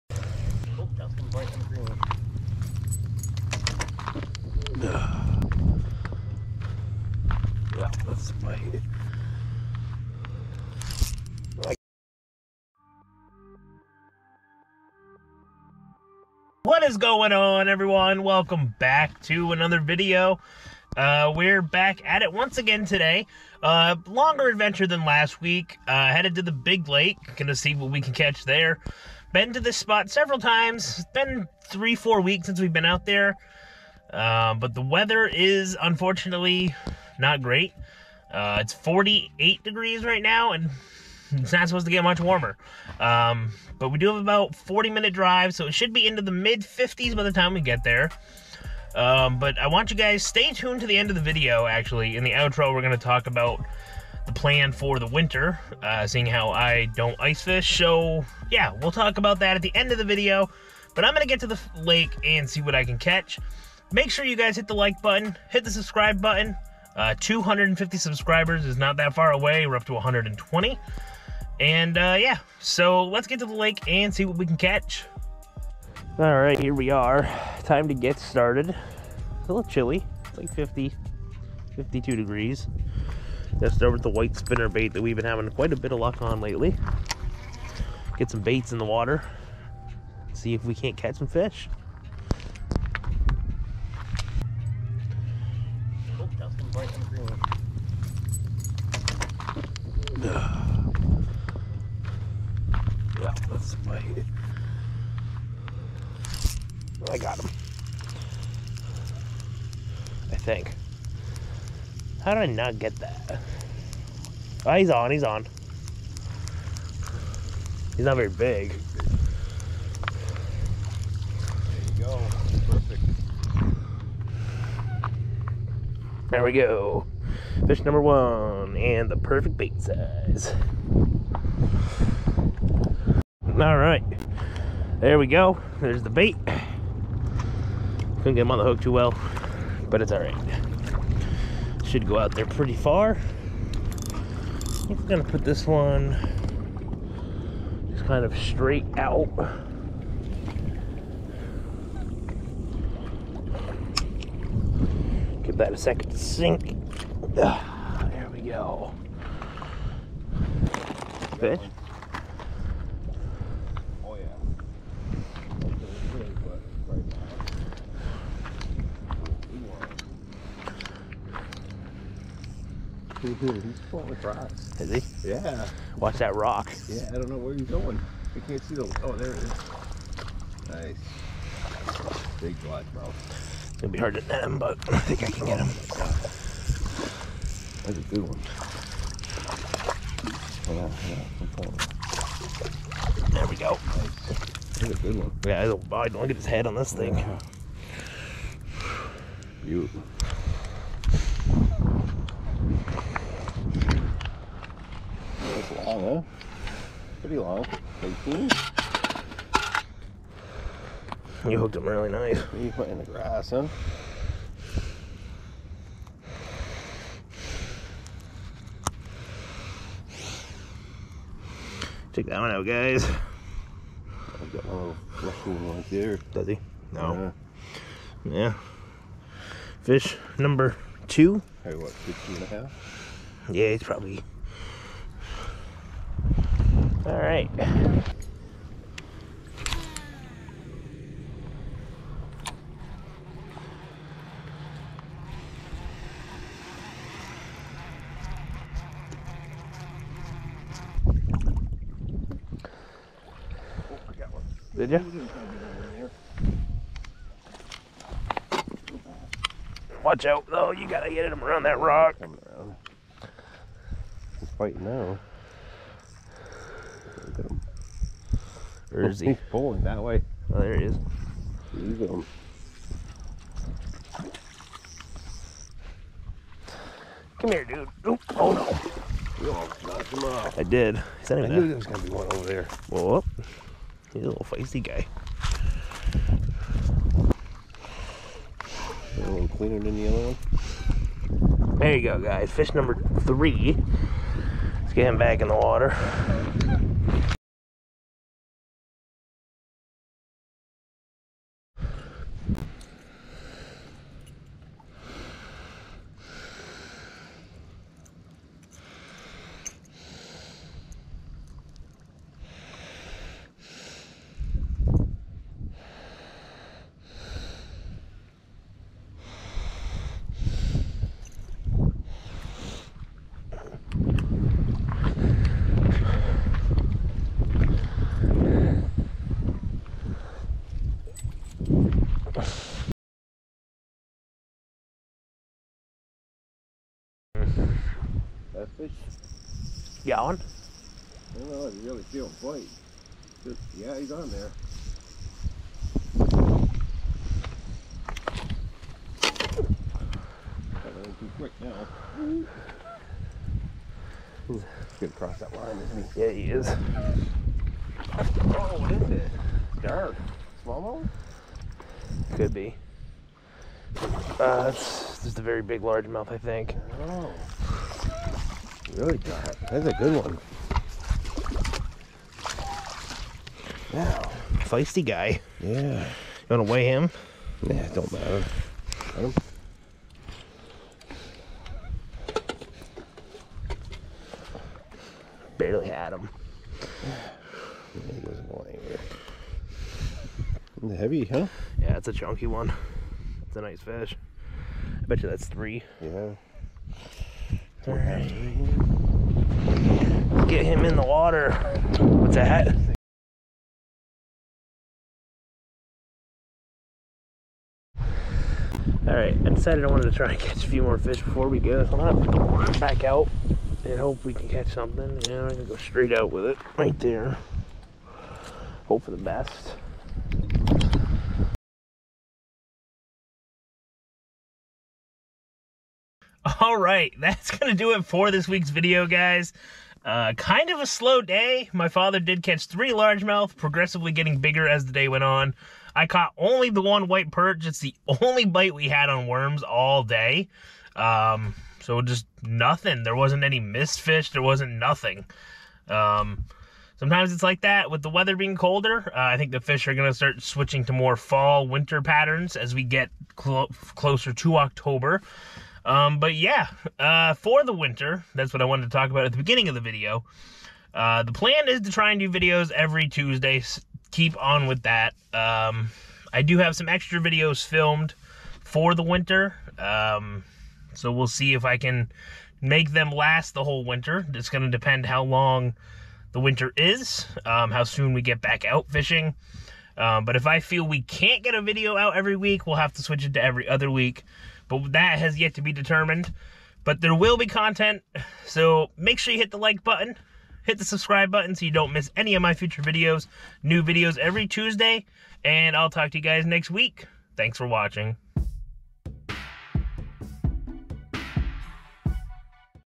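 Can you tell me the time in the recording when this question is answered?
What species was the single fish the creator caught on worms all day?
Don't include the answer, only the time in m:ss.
7:17.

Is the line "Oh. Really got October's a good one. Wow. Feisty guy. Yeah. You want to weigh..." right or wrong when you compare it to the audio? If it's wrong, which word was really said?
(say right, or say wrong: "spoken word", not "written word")
wrong: "That", not "October".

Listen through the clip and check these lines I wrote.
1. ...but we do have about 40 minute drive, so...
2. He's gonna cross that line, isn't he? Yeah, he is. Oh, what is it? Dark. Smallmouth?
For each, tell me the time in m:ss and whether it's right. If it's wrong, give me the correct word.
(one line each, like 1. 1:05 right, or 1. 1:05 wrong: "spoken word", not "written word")
1. 0:43 right
2. 5:54 right.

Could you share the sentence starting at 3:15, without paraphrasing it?
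Yeah, Look at his head on this thing.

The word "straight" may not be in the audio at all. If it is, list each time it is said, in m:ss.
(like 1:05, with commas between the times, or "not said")
2:28, 6:55.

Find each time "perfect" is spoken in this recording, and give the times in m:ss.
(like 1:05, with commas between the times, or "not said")
2:02, 2:09.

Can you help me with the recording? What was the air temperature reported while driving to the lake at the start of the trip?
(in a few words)
48 degrees.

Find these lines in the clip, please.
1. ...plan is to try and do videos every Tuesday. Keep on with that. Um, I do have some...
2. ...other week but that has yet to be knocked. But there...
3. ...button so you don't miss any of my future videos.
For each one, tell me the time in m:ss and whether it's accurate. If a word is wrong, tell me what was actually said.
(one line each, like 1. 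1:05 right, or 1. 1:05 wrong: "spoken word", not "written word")
1. 7:41 right
2. 8:03 wrong: "determined", not "knocked"
3. 8:11 right.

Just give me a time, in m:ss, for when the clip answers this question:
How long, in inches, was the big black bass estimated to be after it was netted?
3:28.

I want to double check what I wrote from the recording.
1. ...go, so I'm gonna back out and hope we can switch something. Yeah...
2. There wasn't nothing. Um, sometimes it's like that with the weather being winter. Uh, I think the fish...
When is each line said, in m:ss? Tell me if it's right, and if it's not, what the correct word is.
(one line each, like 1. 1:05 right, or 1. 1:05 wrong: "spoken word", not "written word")
1. 6:51 wrong: "catch", not "switch"
2. 7:24 wrong: "colder", not "winter".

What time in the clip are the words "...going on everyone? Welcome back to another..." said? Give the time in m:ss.
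0:16.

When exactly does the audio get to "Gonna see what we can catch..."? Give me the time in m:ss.
0:27.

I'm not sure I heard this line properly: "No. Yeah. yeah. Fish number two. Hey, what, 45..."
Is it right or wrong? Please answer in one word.
wrong.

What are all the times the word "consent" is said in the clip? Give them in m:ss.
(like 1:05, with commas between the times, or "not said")
not said.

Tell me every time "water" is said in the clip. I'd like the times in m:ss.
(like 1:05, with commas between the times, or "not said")
1:28, 4:55, 6:41.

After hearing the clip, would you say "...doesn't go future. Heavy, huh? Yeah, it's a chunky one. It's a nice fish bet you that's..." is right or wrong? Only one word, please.
wrong.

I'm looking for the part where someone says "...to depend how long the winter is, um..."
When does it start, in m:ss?
7:54.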